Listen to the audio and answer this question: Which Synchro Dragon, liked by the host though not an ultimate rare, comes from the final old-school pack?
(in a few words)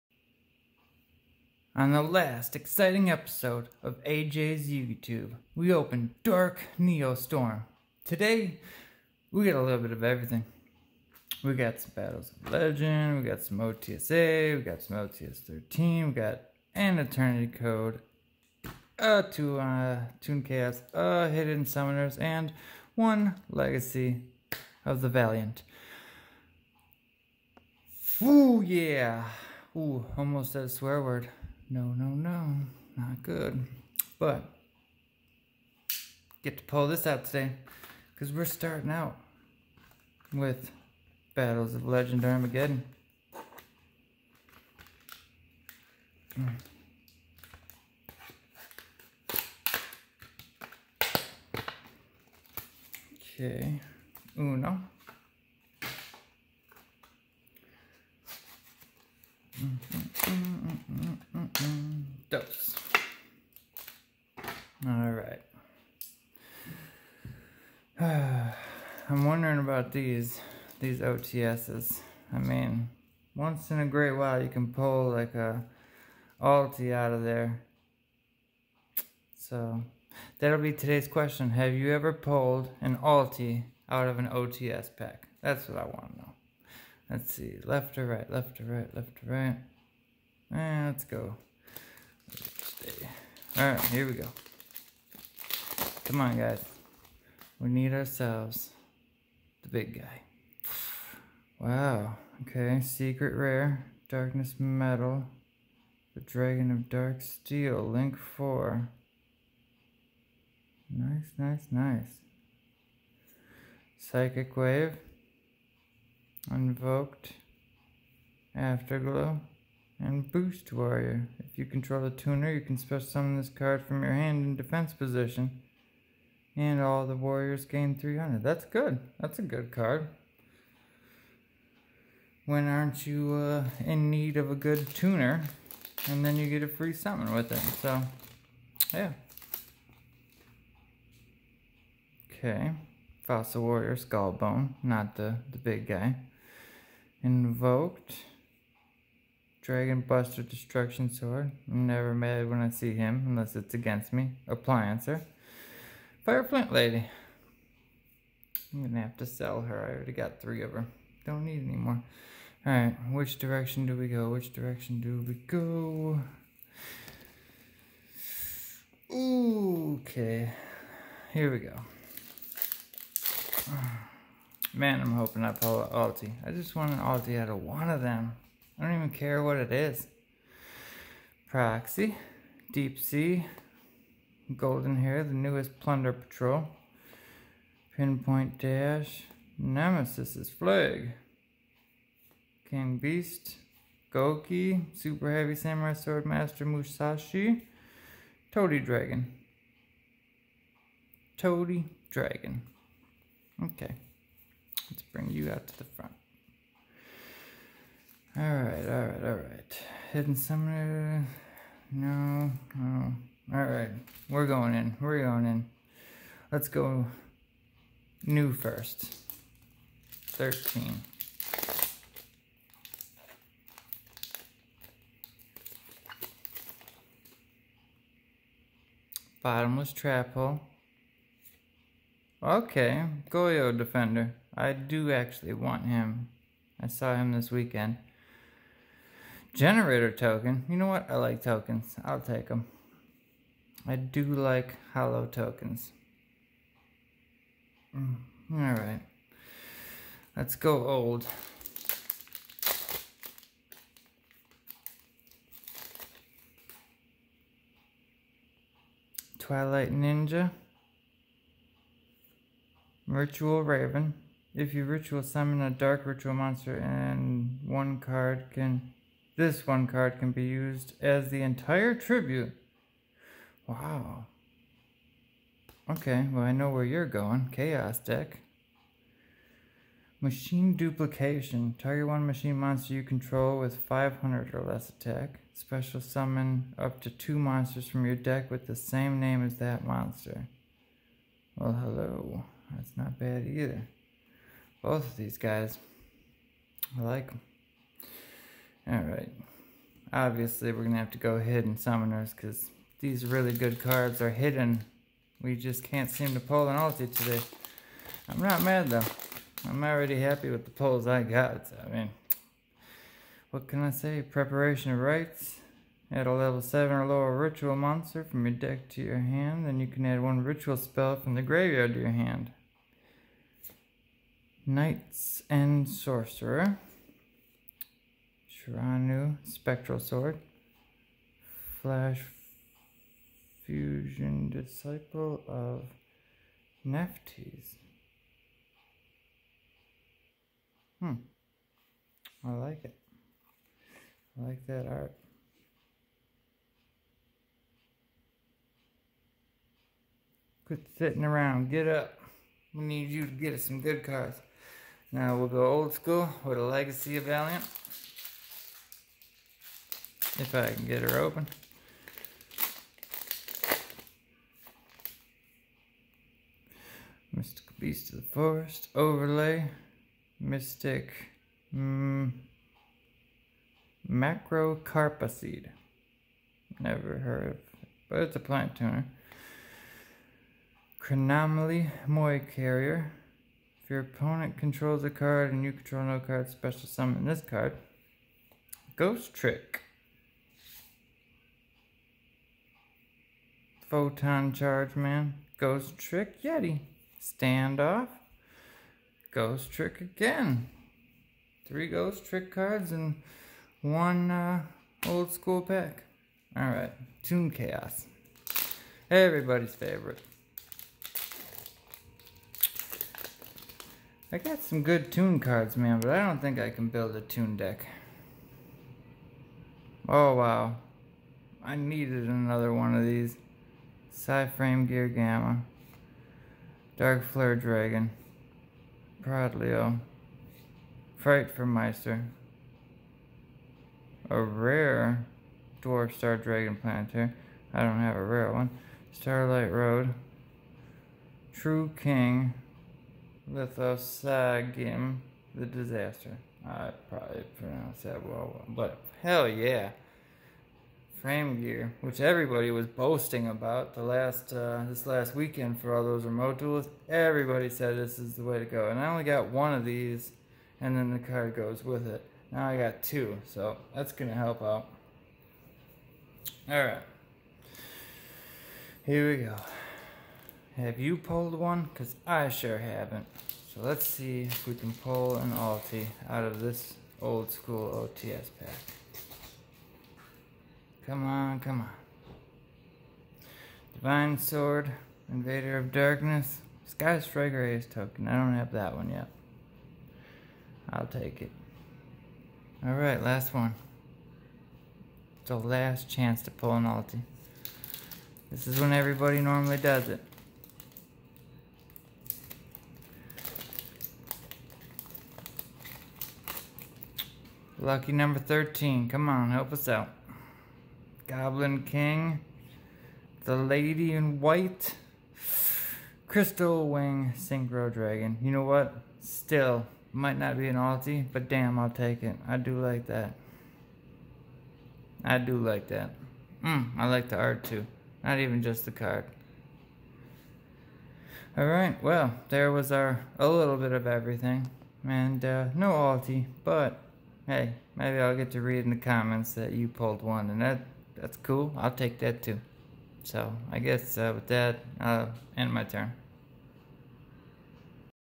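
Crystal Wing Synchro Dragon.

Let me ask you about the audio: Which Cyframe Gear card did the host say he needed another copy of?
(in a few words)
Cyframe Gear Gamma.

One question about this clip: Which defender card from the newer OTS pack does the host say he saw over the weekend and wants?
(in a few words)
Goyo Defender.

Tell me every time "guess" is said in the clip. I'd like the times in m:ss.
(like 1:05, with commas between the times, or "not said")
9:03.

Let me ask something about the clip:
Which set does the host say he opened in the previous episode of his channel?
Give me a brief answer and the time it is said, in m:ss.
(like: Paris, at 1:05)
Dark Neo Storm, at 0:06.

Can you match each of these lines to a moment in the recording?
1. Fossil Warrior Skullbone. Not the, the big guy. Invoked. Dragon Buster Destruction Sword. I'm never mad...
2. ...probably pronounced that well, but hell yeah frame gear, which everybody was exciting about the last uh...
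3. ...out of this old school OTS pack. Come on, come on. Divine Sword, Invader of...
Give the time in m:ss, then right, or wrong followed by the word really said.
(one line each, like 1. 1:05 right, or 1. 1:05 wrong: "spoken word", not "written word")
1. 2:23 right
2. 7:27 wrong: "boasting", not "exciting"
3. 7:56 right.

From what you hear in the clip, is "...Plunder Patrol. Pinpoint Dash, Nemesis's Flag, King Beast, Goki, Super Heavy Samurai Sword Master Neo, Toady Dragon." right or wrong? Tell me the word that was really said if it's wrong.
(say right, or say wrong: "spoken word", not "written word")
wrong: "Musashi", not "Neo".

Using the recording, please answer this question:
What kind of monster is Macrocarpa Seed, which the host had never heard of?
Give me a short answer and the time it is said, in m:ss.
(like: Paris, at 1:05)
plant tuner, at 6:18.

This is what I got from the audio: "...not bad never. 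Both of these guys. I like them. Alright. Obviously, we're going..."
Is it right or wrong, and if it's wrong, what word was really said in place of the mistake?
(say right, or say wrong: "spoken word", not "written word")
wrong: "either", not "never".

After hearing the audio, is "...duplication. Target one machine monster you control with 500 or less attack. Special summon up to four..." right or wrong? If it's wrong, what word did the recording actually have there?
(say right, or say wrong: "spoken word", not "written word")
wrong: "two", not "four".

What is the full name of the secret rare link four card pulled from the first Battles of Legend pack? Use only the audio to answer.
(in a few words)
Darkness Metal, the Dragon of Dark Steel.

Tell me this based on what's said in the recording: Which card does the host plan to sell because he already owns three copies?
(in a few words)
Fireplant Lady.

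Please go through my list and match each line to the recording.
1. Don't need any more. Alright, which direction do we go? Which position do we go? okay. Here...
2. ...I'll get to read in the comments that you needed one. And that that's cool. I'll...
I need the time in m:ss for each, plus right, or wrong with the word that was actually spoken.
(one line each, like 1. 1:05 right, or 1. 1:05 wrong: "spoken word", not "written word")
1. 2:41 wrong: "direction", not "position"
2. 8:58 wrong: "pulled", not "needed".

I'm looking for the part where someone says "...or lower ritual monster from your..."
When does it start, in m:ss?
5:16.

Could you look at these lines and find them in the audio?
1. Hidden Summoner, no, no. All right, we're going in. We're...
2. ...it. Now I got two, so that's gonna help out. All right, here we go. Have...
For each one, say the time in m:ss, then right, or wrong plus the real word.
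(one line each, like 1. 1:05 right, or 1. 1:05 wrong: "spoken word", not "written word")
1. 3:30 right
2. 7:42 right.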